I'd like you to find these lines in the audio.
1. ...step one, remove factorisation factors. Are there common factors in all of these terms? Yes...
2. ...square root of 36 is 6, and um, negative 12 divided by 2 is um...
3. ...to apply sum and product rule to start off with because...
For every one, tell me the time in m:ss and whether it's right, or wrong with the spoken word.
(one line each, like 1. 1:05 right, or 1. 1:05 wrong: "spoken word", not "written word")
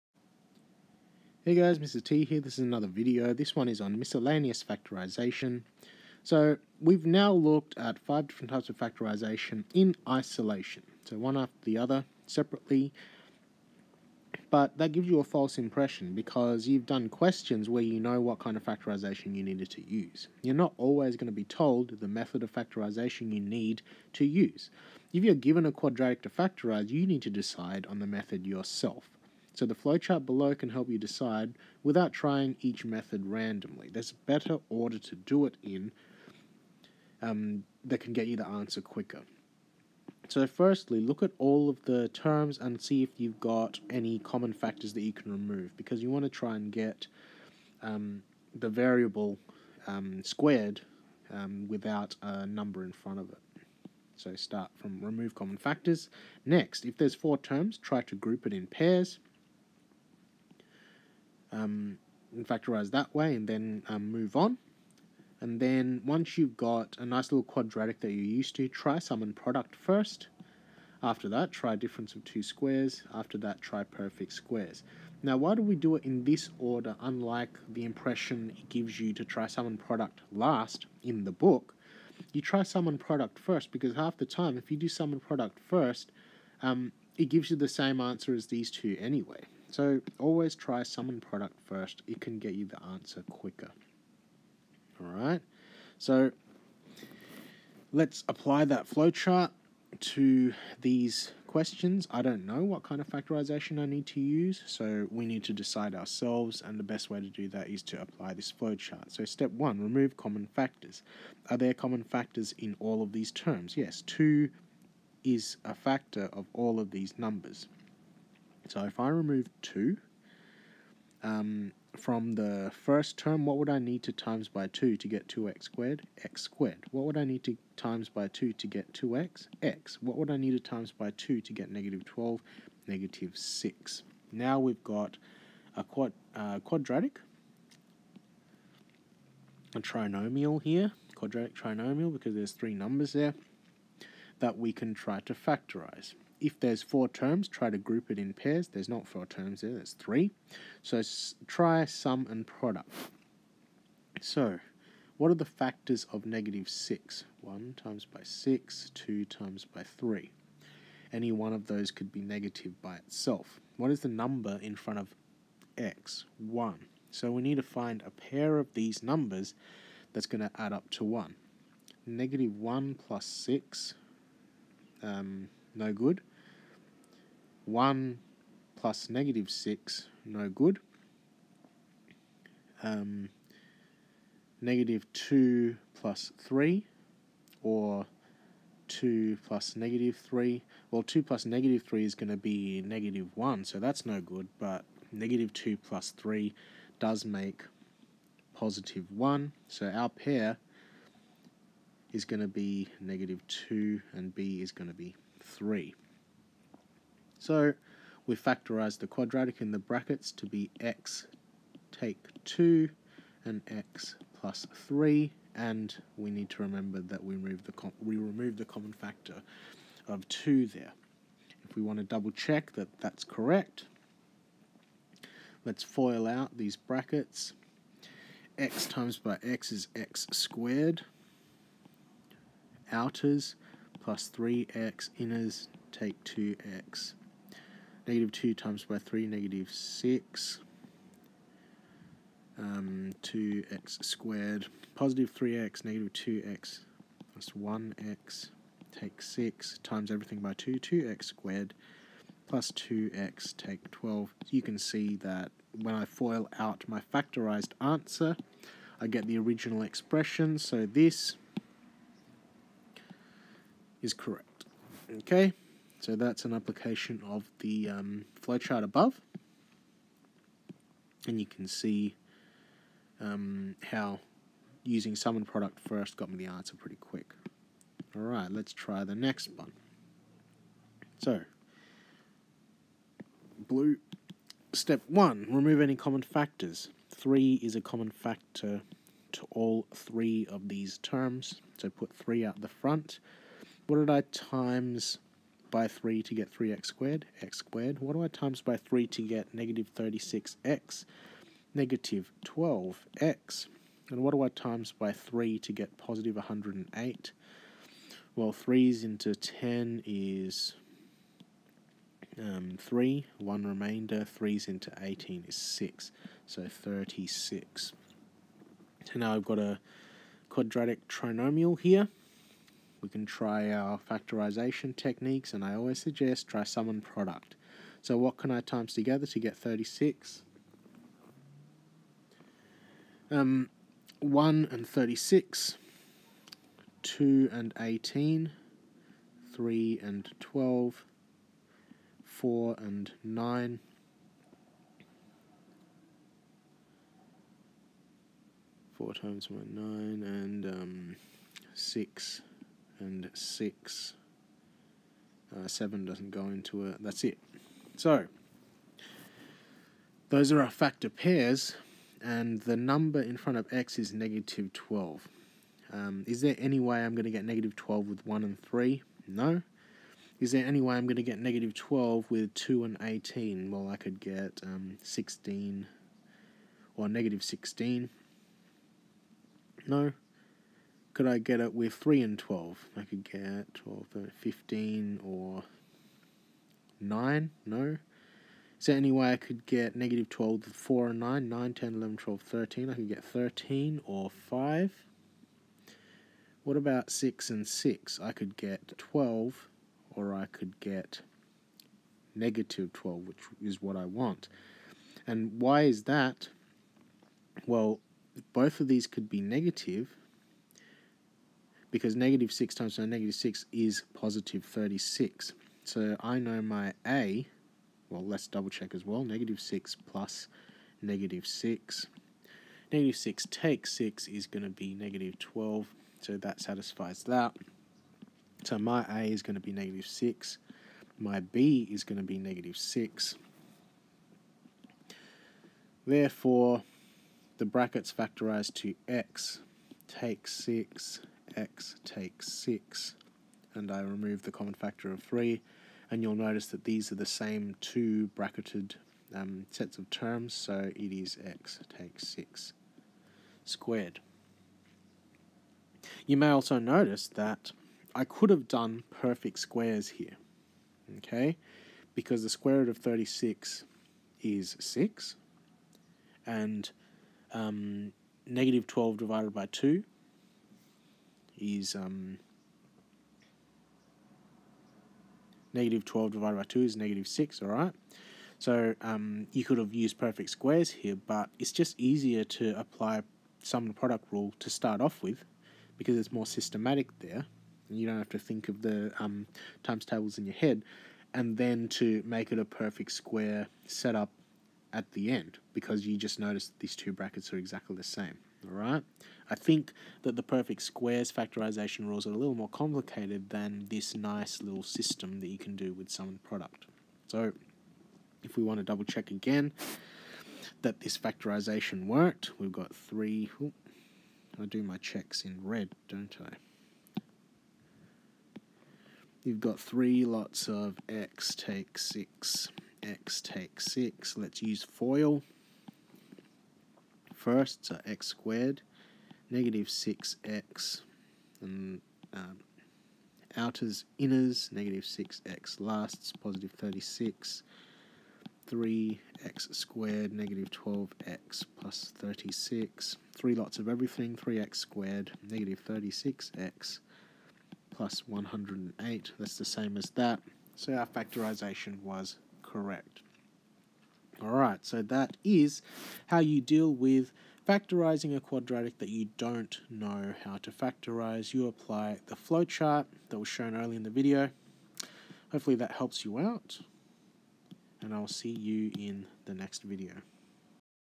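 1. 1:49 wrong: "common", not "factorisation"
2. 7:42 right
3. 8:02 right.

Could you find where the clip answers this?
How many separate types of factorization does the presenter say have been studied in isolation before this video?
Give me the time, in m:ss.
0:07.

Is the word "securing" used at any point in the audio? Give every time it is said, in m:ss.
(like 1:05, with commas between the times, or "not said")
not said.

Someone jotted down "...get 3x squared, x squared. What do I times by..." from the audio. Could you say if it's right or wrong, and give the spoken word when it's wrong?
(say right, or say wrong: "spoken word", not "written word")
right.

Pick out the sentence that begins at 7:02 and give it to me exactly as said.
Negative 6 takes 6 is going to be negative 12, so that satisfies that.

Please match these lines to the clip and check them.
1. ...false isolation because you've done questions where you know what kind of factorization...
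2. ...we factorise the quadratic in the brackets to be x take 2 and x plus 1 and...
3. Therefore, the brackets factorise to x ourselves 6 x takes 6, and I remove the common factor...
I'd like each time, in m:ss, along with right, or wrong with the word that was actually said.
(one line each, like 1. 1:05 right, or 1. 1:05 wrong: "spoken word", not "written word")
1. 0:15 wrong: "impression", not "isolation"
2. 3:28 wrong: "3", not "1"
3. 7:16 wrong: "takes", not "ourselves".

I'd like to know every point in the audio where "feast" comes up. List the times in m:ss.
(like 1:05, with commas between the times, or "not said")
not said.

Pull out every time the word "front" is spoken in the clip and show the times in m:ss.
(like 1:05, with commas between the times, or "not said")
0:52, 2:44, 4:52, 6:03.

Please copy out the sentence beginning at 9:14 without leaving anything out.
Alright, so that is how you deal with factorizing a quadratic that you don't know how to factorize.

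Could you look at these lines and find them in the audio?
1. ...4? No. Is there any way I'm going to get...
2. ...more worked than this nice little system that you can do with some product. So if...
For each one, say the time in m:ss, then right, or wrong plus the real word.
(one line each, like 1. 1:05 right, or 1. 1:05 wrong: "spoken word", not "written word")
1. 6:08 wrong: "3", not "4"
2. 8:22 wrong: "complicated", not "worked".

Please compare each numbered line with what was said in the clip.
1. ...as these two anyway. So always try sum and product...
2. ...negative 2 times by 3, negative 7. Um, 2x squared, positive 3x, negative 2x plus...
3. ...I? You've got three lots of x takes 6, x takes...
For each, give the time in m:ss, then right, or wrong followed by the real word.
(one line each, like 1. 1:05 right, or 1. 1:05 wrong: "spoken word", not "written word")
1. 1:28 right
2. 3:58 wrong: "6", not "7"
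3. 8:36 right.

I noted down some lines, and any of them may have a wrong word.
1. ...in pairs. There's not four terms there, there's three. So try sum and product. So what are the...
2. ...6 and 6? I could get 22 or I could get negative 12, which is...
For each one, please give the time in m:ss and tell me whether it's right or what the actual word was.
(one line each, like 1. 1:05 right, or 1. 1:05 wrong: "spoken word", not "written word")
1. 2:28 right
2. 6:37 wrong: "12", not "22".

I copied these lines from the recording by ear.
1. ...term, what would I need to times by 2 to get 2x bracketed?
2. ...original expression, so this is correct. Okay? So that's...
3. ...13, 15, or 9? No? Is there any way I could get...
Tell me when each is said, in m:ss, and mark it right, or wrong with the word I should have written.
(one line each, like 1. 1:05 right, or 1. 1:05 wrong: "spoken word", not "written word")
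1. 2:03 wrong: "squared", not "bracketed"
2. 4:19 right
3. 6:24 right.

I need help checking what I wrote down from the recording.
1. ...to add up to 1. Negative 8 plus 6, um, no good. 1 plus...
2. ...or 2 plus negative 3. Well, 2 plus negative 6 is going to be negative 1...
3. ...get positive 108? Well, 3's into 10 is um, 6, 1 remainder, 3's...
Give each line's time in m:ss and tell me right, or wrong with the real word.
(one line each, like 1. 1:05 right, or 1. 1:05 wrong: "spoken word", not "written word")
1. 2:50 wrong: "1", not "8"
2. 3:07 wrong: "3", not "6"
3. 5:05 wrong: "3", not "6".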